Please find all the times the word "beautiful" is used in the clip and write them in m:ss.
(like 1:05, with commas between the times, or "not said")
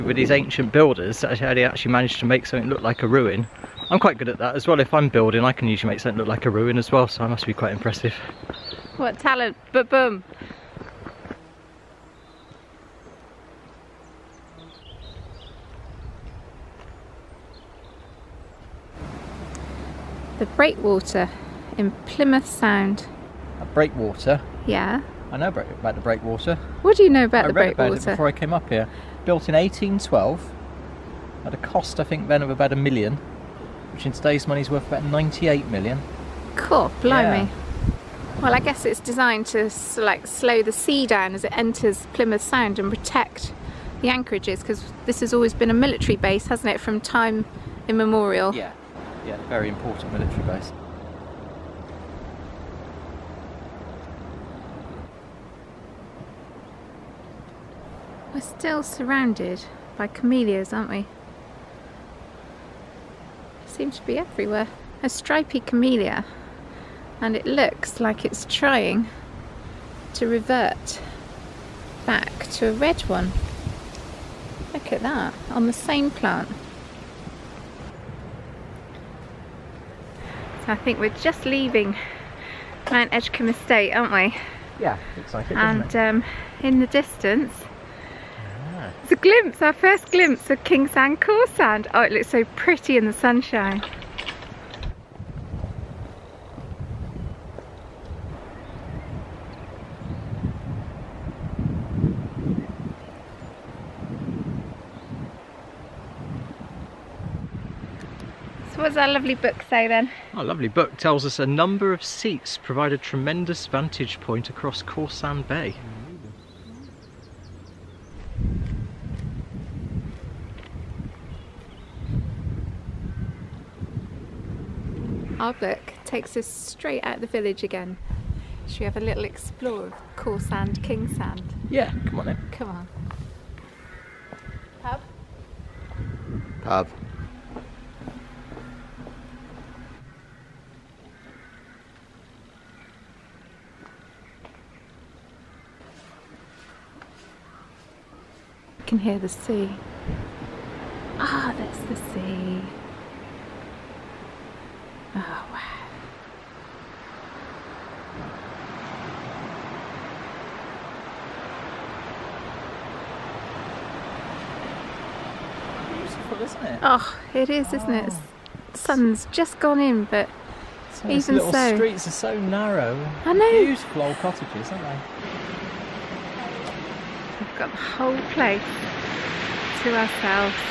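2:46, 2:53.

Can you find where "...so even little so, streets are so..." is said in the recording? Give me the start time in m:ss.
2:50.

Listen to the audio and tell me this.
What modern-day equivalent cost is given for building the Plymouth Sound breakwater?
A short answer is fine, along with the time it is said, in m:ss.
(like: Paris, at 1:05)
about 98 million, at 0:34.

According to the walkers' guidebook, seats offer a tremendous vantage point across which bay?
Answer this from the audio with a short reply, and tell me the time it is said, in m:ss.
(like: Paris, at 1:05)
Cawsand Bay, at 1:54.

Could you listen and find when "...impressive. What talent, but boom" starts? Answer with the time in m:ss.
0:07.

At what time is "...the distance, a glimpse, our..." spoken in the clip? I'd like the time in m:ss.
1:26.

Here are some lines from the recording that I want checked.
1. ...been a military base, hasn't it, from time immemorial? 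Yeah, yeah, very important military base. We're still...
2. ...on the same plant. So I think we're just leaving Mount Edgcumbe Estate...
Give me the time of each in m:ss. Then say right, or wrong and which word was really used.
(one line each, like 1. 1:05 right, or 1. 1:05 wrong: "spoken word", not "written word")
1. 0:45 right
2. 1:15 right.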